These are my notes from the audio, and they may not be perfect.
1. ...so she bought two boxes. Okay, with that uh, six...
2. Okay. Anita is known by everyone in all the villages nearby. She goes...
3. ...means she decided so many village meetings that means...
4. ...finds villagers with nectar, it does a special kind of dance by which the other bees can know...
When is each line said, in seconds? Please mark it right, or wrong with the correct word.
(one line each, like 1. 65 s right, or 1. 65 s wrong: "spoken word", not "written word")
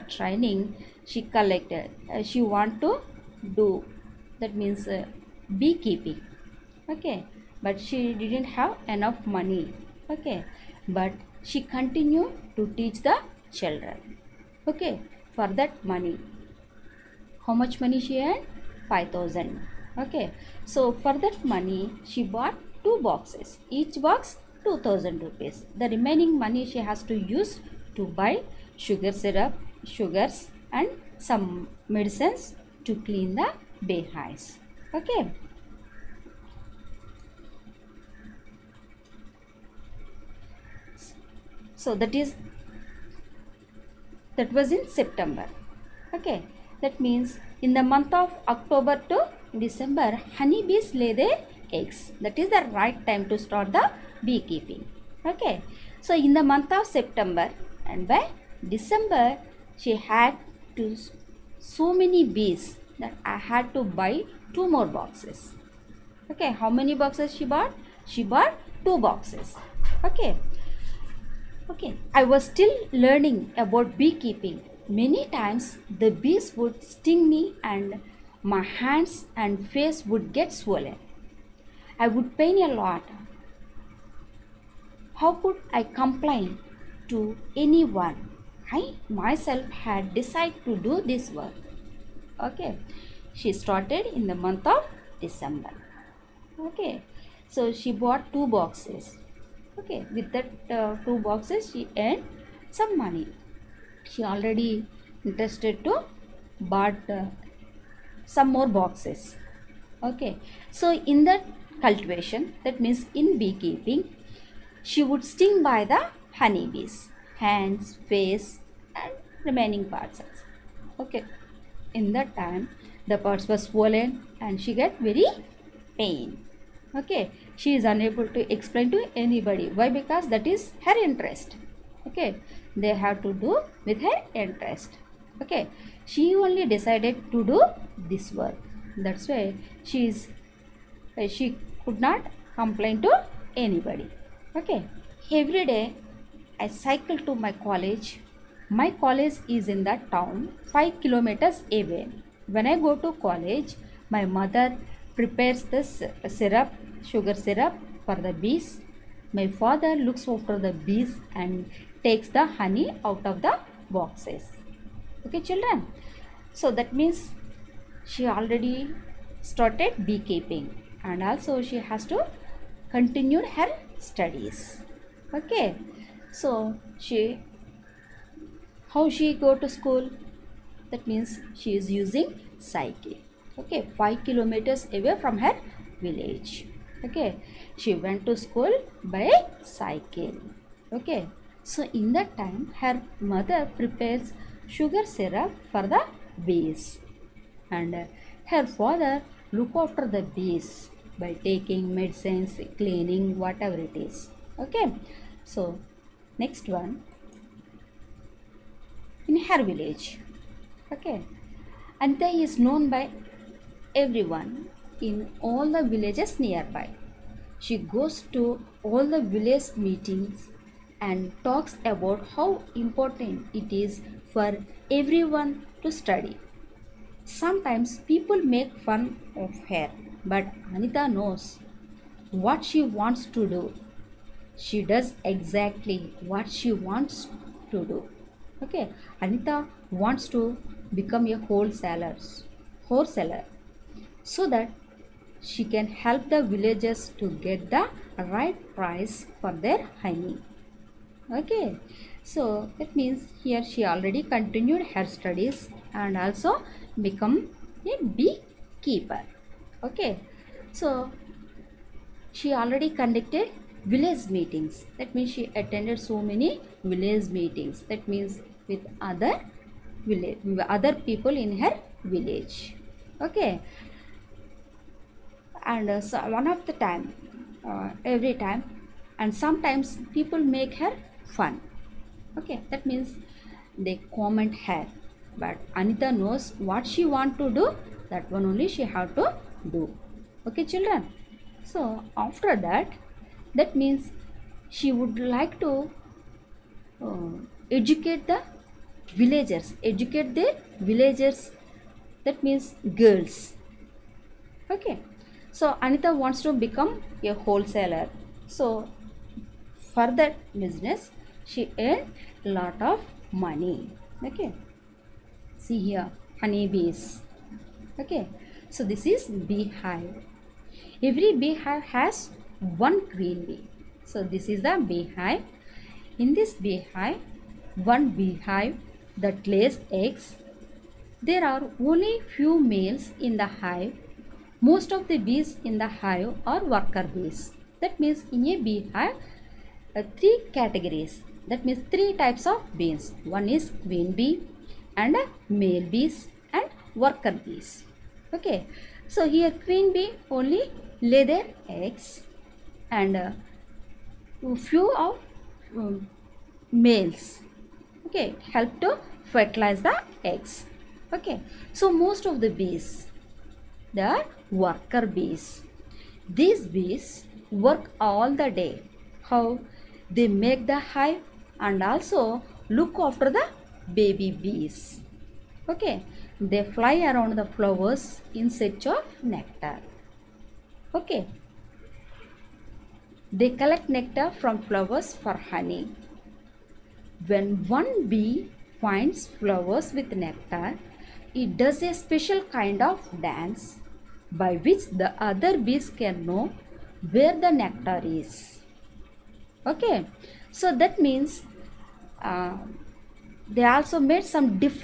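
1. 97 s wrong: "two", not "six"
2. 210 s right
3. 265 s wrong: "attended", not "decided"
4. 388 s wrong: "flowers", not "villagers".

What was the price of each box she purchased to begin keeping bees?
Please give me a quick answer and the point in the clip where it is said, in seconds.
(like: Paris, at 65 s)
2000 rupees, at 24 s.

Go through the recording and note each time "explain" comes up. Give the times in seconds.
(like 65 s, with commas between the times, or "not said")
128 s.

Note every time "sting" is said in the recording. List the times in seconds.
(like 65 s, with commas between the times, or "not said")
76 s, 115 s.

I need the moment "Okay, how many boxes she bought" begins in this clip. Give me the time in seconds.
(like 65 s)
66 s.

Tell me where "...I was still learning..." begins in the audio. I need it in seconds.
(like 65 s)
72 s.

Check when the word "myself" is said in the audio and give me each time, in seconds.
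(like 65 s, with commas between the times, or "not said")
89 s.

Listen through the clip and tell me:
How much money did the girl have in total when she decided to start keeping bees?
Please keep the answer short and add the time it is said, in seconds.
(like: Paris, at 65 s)
5000, at 18 s.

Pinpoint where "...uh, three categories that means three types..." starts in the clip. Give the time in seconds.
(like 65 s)
339 s.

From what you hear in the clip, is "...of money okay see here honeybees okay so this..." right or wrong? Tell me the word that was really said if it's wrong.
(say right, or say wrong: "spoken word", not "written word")
right.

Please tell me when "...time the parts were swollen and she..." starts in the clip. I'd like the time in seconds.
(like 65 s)
122 s.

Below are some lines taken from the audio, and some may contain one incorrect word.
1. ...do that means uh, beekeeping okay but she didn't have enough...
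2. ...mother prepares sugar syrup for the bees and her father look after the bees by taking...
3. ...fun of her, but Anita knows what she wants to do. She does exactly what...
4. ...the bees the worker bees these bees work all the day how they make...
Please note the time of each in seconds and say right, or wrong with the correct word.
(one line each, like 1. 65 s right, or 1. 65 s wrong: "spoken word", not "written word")
1. 3 s right
2. 193 s right
3. 228 s right
4. 362 s right.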